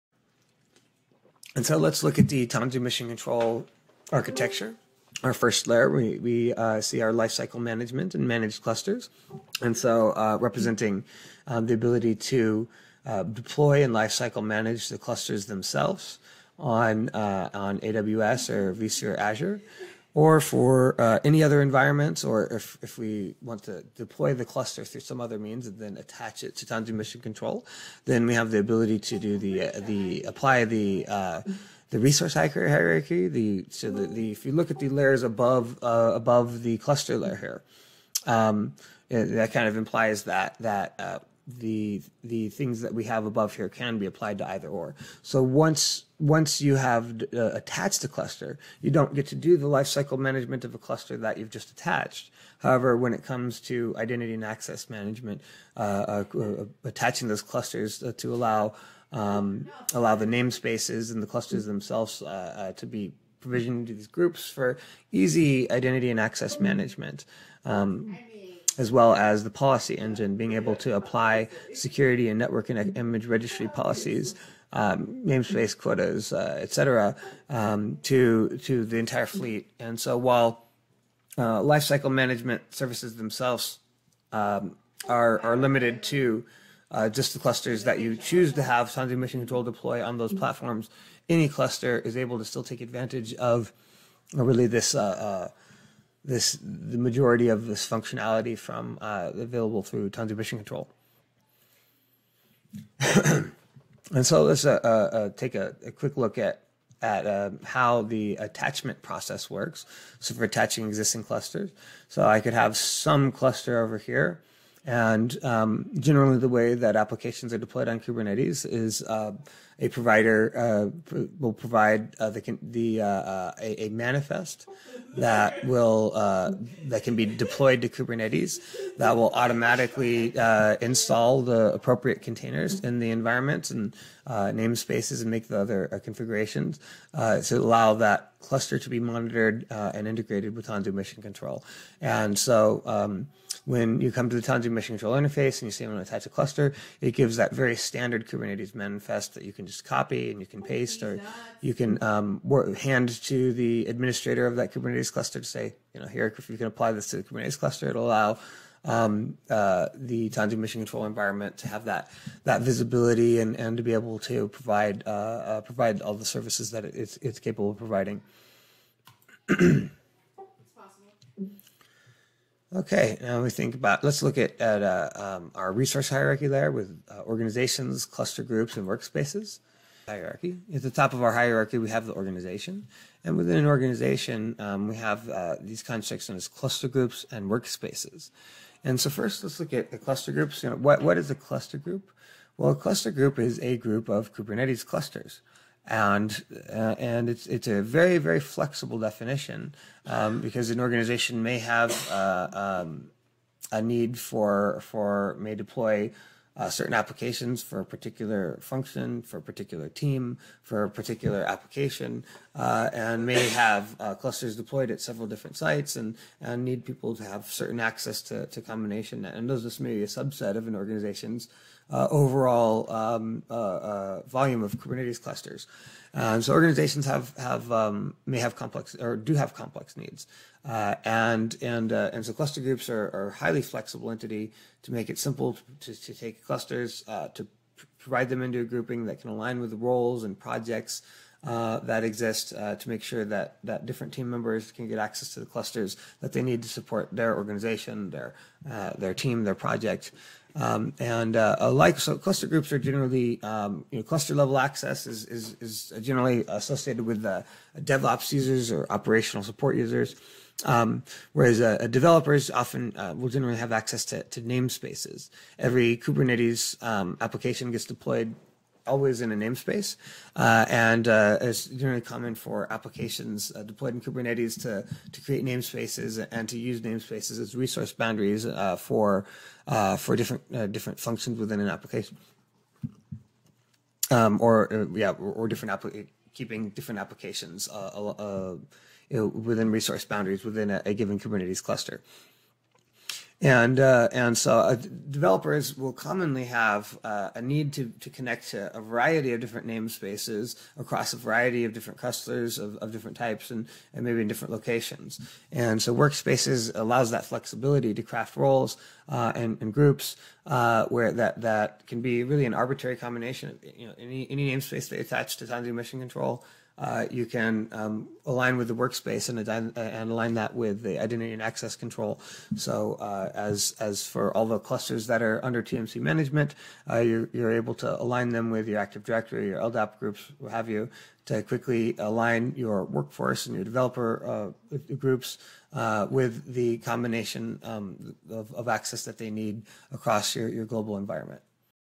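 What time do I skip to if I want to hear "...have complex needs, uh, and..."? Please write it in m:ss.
3:49.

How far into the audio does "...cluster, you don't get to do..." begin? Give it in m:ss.
0:48.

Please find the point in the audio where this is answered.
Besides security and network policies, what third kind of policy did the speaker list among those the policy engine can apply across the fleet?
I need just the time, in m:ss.
1:12.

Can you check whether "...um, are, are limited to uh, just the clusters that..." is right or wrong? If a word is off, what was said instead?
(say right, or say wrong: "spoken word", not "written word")
right.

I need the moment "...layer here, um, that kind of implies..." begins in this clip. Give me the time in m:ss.
0:37.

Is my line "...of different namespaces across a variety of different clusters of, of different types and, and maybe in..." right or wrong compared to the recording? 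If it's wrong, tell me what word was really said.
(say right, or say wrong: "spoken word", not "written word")
right.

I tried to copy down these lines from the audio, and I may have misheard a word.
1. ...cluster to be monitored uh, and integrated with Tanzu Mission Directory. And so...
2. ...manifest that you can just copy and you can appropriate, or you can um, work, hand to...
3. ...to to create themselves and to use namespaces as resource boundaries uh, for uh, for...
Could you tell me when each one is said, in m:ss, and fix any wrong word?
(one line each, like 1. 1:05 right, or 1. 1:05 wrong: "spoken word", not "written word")
1. 2:18 wrong: "Control", not "Directory"
2. 2:28 wrong: "paste", not "appropriate"
3. 4:34 wrong: "namespaces", not "themselves".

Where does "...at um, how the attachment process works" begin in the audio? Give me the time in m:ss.
1:47.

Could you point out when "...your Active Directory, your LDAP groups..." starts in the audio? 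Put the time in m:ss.
5:28.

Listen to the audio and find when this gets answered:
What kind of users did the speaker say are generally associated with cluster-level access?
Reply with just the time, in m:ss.
4:17.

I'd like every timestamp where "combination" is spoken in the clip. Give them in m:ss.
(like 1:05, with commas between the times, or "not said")
3:38, 5:12, 5:36.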